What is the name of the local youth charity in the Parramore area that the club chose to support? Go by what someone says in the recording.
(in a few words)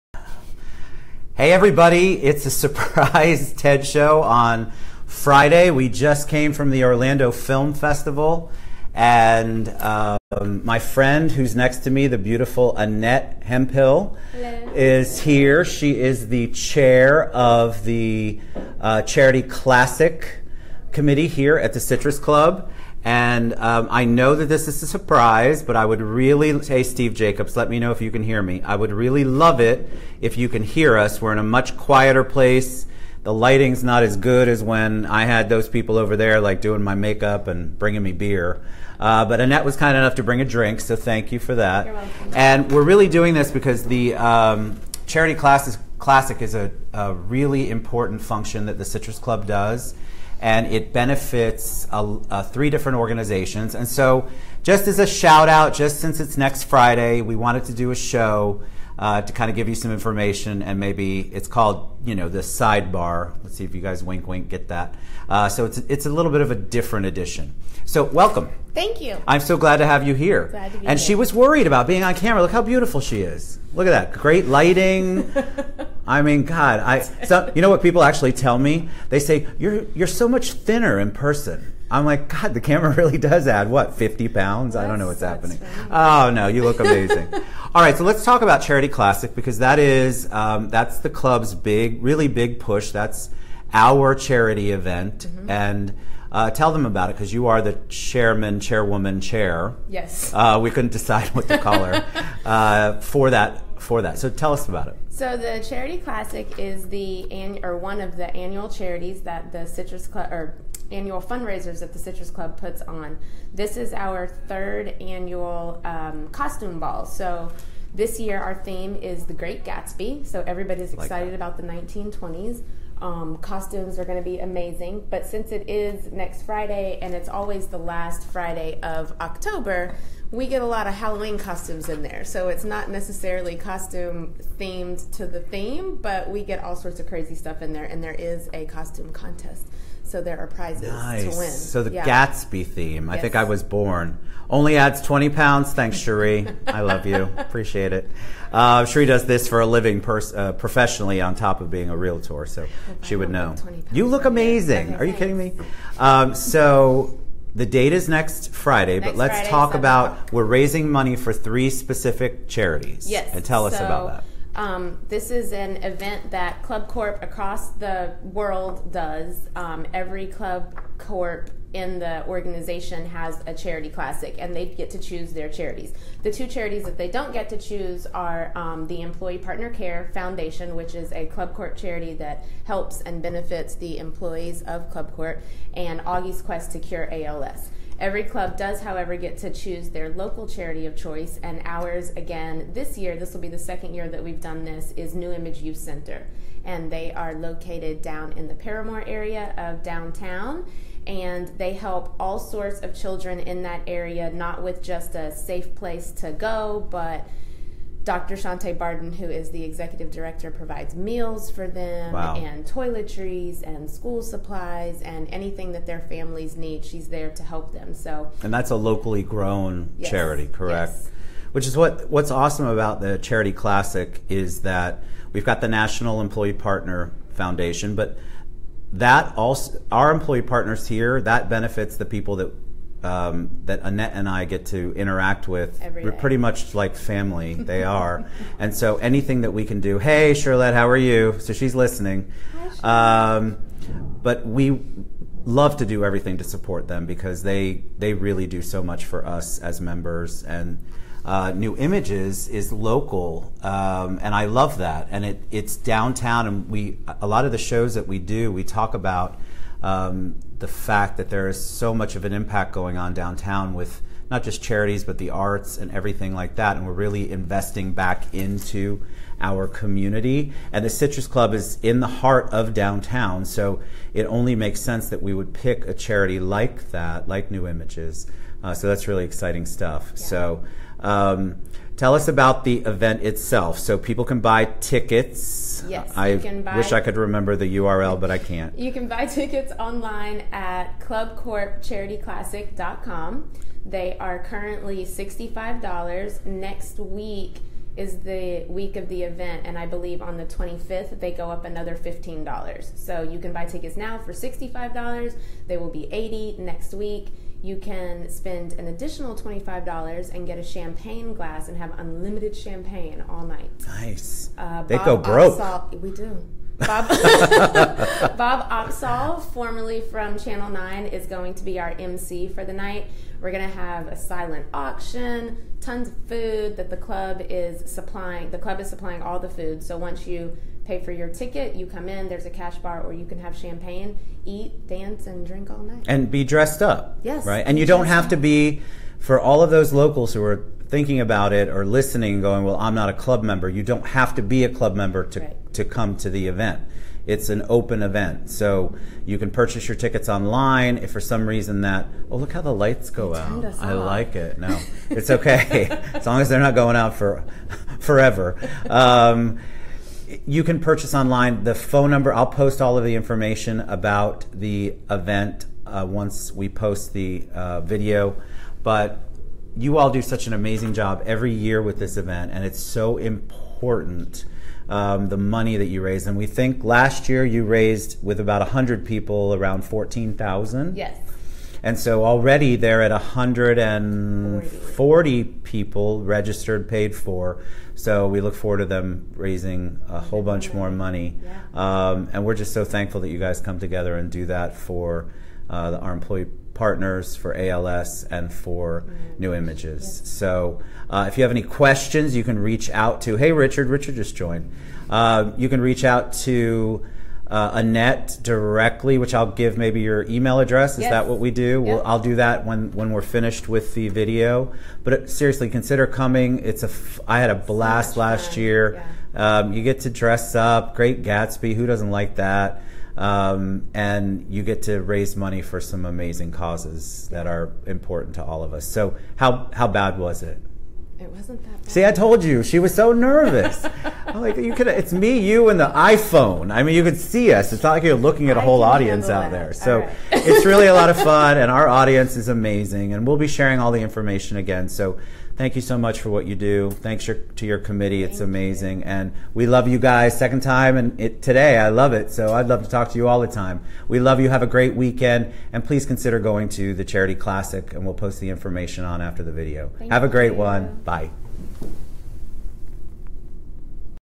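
New Image Youth Center.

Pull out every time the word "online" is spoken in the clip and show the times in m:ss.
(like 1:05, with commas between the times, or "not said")
4:49, 5:50, 6:01.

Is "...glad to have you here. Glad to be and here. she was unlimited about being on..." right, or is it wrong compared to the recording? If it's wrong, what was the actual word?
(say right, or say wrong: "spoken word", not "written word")
wrong: "worried", not "unlimited".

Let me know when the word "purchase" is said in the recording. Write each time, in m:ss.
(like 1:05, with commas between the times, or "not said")
5:49, 6:00.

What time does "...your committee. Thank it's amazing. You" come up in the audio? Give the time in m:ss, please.
7:27.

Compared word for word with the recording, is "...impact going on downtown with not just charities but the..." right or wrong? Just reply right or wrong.
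right.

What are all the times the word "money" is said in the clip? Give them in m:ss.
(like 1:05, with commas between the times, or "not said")
2:40, 6:15, 6:30, 7:05.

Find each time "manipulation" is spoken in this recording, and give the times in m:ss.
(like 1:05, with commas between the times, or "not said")
not said.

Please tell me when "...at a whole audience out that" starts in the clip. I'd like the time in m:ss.
7:18.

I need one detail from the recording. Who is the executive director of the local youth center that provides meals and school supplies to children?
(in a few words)
Dr. Shante Barden.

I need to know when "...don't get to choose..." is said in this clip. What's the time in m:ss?
2:57.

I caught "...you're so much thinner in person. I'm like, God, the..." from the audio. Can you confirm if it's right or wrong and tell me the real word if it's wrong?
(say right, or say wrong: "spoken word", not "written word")
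right.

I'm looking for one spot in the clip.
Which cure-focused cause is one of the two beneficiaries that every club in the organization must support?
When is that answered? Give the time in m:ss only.
3:06.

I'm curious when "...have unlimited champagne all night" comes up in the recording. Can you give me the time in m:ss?
5:11.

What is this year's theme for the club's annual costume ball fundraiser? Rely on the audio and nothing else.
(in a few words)
The Great Gatsby.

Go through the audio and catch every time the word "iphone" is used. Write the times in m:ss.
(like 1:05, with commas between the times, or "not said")
7:15.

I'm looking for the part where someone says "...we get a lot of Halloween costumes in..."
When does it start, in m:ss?
2:10.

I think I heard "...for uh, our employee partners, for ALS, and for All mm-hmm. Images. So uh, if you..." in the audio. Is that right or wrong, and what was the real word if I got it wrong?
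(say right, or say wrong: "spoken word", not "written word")
wrong: "New", not "All".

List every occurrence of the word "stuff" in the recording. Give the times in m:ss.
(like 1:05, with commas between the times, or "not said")
2:17, 4:39.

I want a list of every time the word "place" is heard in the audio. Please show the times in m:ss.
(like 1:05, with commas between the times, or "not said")
0:32, 3:25.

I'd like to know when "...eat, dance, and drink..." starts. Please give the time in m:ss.
5:34.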